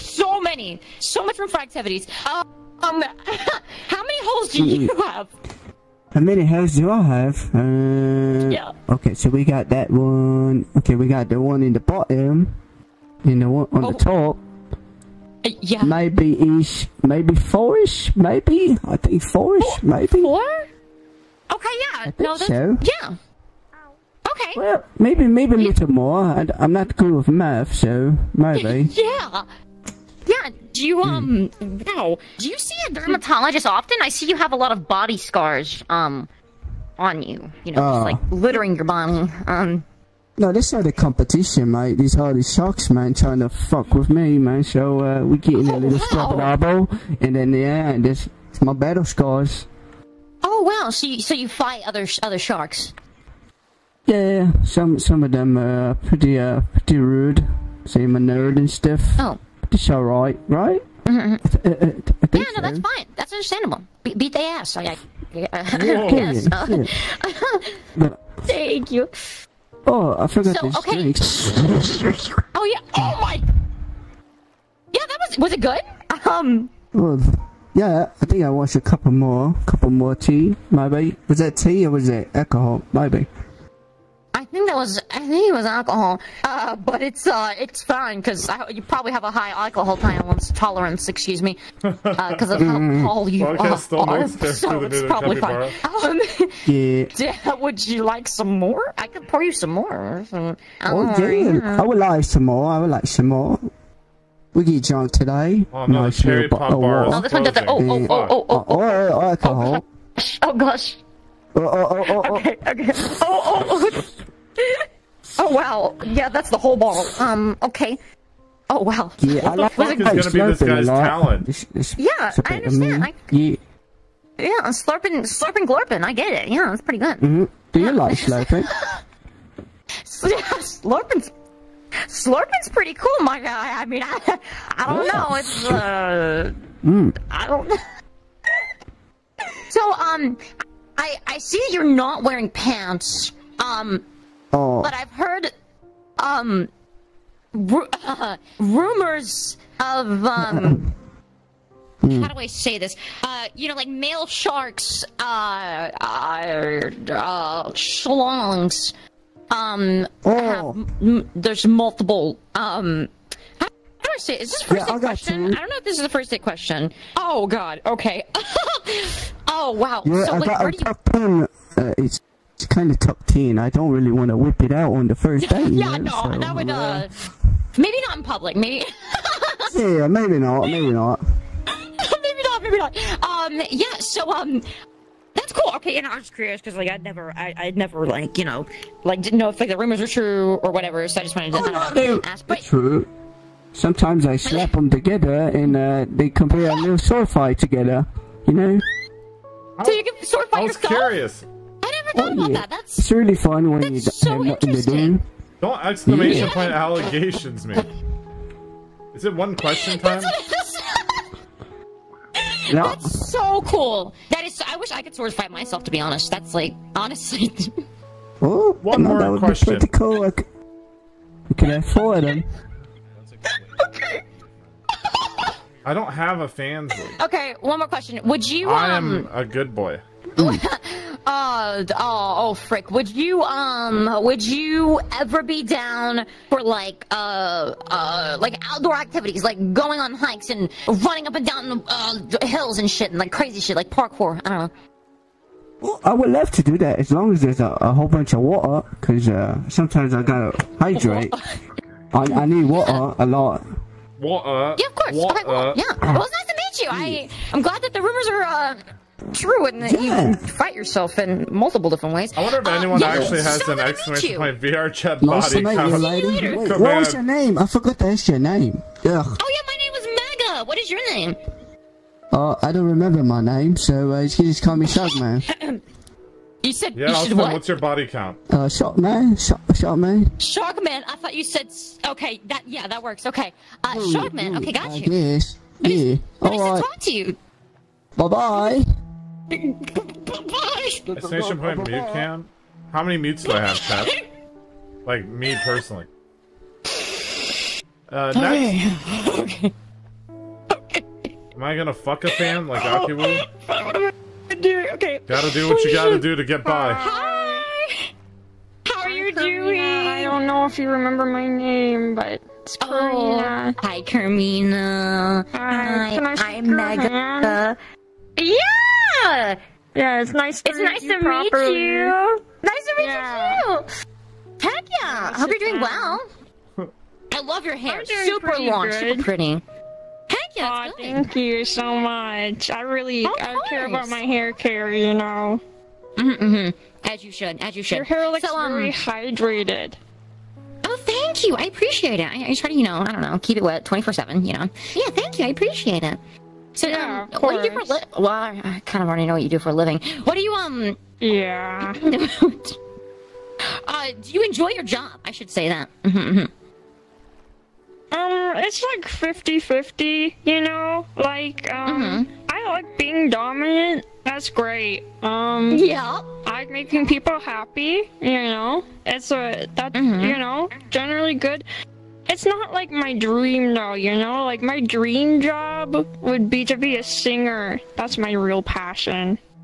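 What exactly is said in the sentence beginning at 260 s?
you fight yourself in multiple different ways.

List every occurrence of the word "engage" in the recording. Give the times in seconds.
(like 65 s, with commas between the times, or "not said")
not said.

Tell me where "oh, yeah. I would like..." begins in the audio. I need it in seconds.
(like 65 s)
100 s.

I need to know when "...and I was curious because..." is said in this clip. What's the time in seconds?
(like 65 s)
185 s.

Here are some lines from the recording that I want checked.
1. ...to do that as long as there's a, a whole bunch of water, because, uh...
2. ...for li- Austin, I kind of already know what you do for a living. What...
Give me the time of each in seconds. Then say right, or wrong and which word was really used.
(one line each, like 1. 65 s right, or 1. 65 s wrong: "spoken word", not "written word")
1. 246 s right
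2. 347 s wrong: "Well", not "Austin".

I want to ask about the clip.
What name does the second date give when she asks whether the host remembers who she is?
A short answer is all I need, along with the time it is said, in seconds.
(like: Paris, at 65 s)
Kermina, at 312 s.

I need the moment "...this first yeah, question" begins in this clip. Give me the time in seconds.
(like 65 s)
164 s.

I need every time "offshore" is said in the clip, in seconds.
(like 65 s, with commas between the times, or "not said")
not said.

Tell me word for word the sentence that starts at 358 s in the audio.
um, it's like 50-50, you know?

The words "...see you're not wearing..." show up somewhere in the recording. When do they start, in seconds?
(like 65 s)
141 s.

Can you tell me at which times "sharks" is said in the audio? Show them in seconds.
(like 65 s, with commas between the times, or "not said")
42 s, 52 s, 154 s.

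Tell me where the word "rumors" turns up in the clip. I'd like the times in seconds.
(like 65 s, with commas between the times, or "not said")
148 s, 189 s, 258 s.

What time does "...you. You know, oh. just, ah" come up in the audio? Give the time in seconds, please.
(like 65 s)
37 s.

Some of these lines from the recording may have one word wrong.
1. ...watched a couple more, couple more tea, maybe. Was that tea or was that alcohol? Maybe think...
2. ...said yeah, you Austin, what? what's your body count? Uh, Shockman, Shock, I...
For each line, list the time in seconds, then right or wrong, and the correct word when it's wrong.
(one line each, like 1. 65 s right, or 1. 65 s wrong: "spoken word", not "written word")
1. 78 s right
2. 276 s right.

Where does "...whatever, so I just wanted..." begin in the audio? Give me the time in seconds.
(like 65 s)
190 s.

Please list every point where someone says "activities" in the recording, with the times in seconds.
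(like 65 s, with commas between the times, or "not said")
1 s, 238 s.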